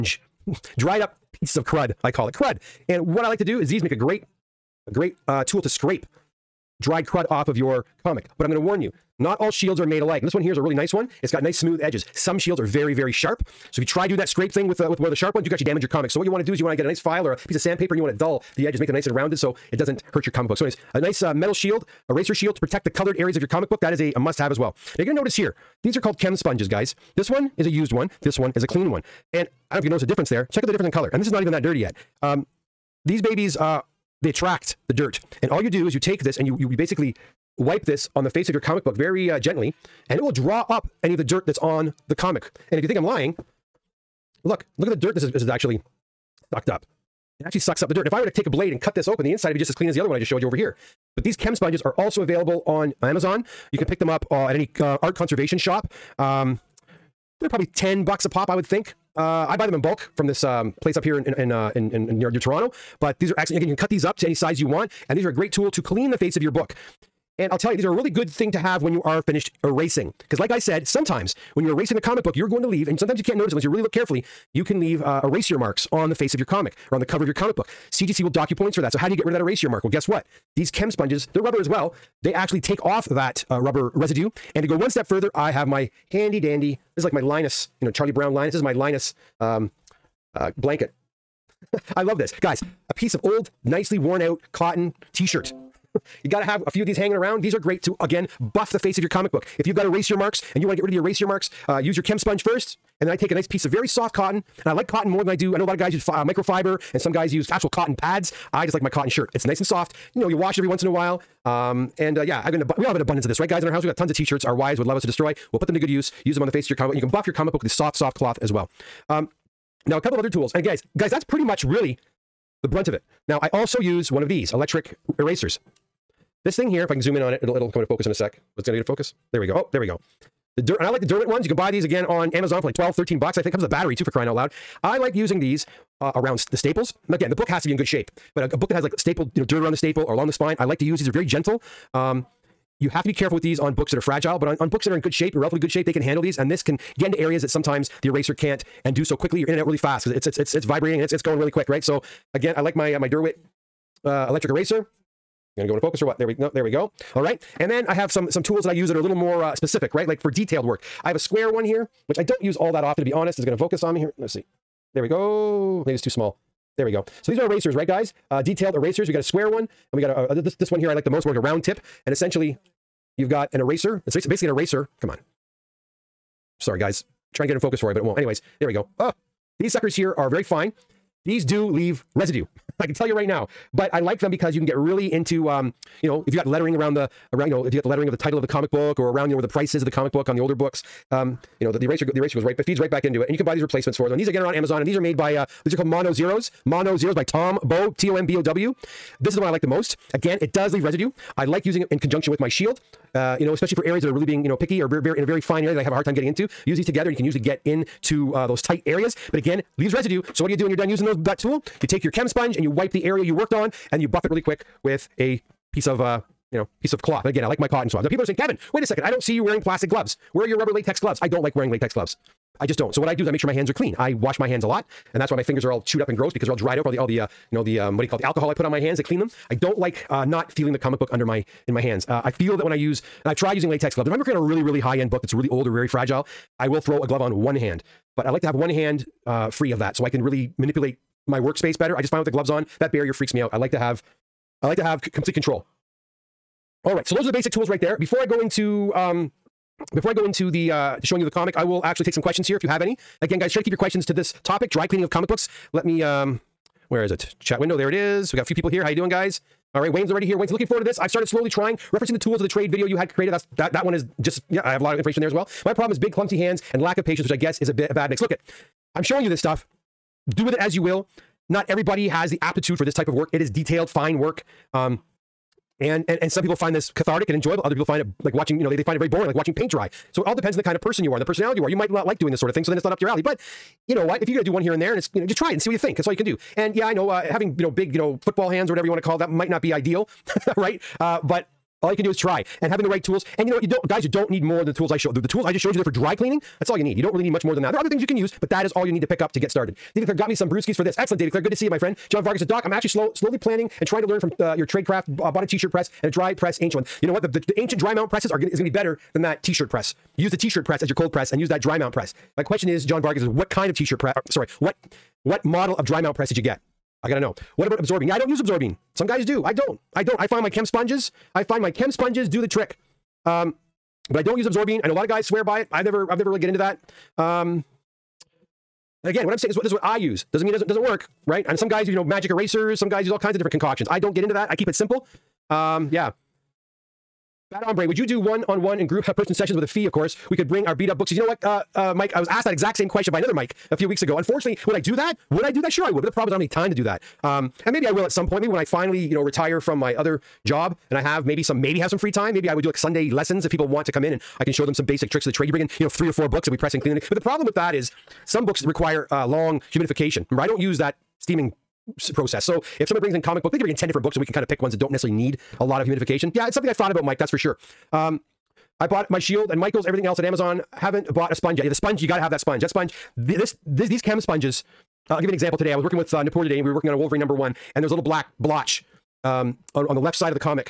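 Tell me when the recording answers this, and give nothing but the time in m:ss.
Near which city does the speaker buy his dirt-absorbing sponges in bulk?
1:02.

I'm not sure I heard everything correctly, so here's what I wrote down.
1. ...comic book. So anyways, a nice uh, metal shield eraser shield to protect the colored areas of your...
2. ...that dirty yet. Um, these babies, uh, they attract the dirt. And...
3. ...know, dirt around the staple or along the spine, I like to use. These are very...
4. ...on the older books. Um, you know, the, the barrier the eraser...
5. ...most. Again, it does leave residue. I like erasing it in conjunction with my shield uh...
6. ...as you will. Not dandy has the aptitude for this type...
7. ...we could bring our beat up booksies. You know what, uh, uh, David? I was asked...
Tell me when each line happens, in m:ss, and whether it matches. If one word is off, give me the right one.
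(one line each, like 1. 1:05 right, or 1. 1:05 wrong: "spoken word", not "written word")
1. 0:20 right
2. 0:31 right
3. 2:19 right
4. 3:10 wrong: "eraser", not "barrier"
5. 3:19 wrong: "using", not "erasing"
6. 4:30 wrong: "everybody", not "dandy"
7. 5:40 wrong: "Mike", not "David".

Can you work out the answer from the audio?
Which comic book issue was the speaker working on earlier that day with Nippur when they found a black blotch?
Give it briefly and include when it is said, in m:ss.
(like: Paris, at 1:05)
Wolverine #1, at 6:16.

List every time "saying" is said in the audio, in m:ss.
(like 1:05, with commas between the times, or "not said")
3:38, 5:29.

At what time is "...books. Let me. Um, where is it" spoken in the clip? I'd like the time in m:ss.
4:15.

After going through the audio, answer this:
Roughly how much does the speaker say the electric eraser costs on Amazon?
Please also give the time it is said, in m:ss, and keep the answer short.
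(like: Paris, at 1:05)
12, 13 bucks, at 2:12.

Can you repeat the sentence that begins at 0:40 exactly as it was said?
And it will draw up any of the dirt that's on the comic.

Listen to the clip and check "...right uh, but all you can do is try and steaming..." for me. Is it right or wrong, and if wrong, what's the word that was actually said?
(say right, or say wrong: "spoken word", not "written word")
wrong: "having", not "steaming".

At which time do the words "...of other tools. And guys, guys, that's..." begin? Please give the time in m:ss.
2:00.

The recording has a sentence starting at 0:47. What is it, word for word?
It actually sucks up the dirt.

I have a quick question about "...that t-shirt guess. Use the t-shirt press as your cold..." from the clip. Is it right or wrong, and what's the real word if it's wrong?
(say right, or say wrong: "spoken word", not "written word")
wrong: "press", not "guess".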